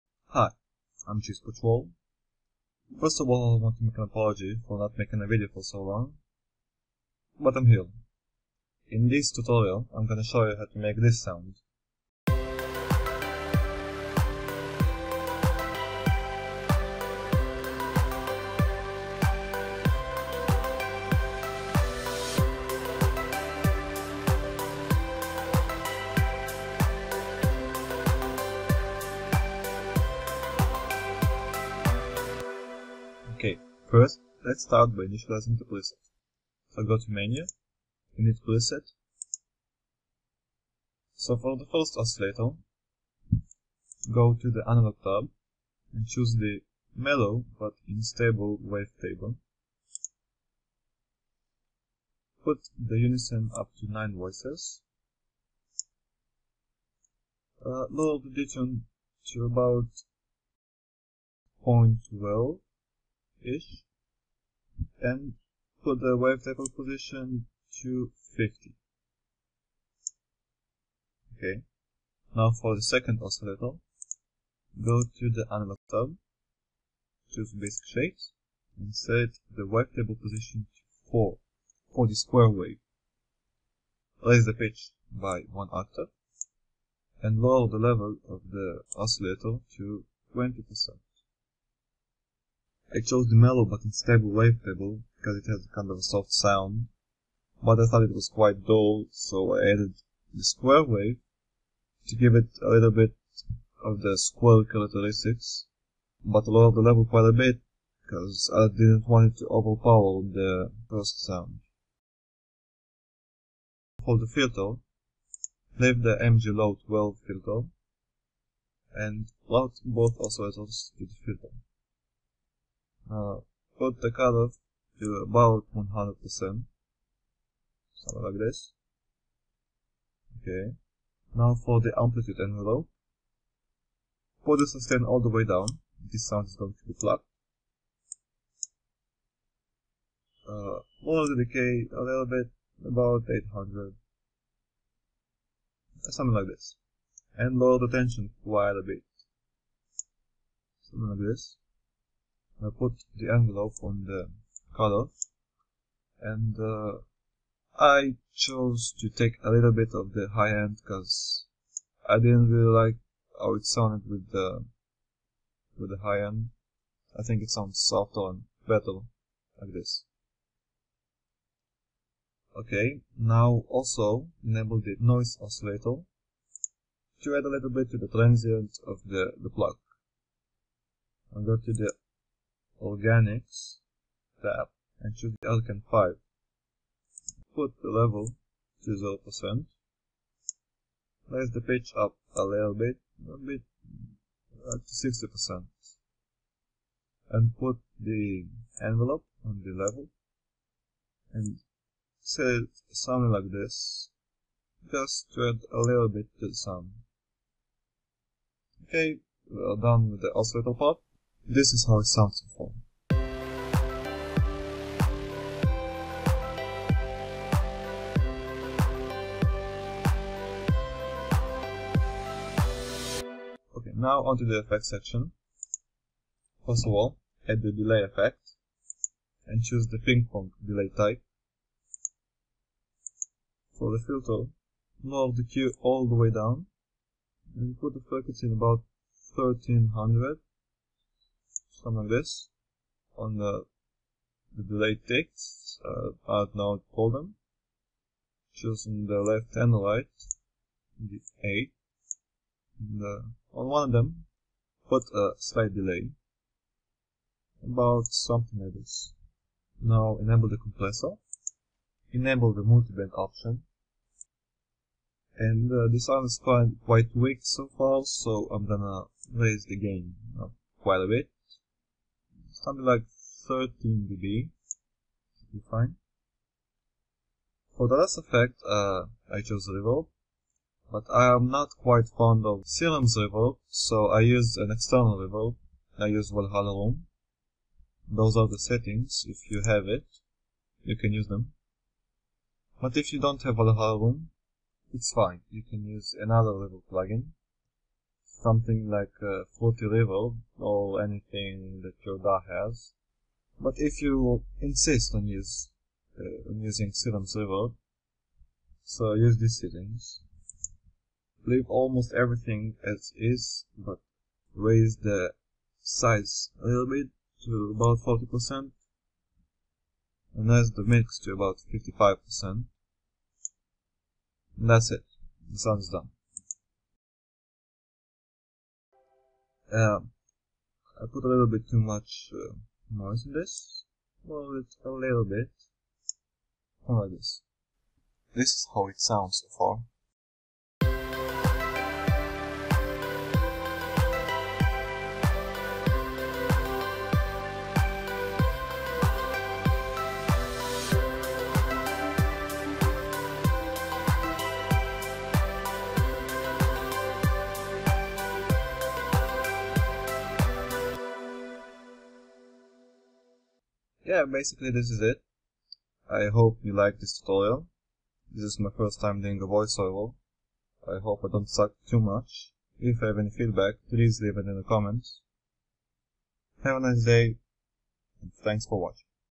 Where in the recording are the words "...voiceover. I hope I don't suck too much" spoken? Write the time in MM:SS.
06:09.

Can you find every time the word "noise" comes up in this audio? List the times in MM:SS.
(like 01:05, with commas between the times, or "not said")
02:54, 05:32.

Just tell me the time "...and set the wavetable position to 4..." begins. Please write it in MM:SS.
01:18.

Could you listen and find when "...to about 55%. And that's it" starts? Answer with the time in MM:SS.
05:21.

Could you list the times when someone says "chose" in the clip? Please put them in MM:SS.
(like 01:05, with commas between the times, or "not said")
01:32, 02:38, 04:39.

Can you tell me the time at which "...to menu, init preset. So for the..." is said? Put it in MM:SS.
00:36.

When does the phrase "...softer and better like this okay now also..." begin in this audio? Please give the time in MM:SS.
02:47.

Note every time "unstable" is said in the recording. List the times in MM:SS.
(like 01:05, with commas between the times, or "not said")
00:47, 01:33.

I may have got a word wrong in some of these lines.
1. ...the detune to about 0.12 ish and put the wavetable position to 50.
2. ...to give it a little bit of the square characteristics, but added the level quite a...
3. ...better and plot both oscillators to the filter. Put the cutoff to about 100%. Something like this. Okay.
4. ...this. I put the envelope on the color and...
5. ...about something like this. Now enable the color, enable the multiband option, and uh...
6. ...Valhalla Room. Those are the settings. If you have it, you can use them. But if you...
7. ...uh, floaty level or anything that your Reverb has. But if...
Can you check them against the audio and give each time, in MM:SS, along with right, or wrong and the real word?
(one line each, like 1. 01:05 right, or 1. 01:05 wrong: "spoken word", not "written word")
1. 00:58 right
2. 01:42 wrong: "lowered", not "added"
3. 01:57 wrong: "filter", not "better"
4. 02:31 right
5. 04:17 wrong: "compressor", not "color"
6. 04:46 right
7. 04:59 wrong: "DAW", not "Reverb".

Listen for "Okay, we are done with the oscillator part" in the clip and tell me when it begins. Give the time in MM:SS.
03:28.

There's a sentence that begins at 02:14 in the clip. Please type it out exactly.
Put the sustain all the way down.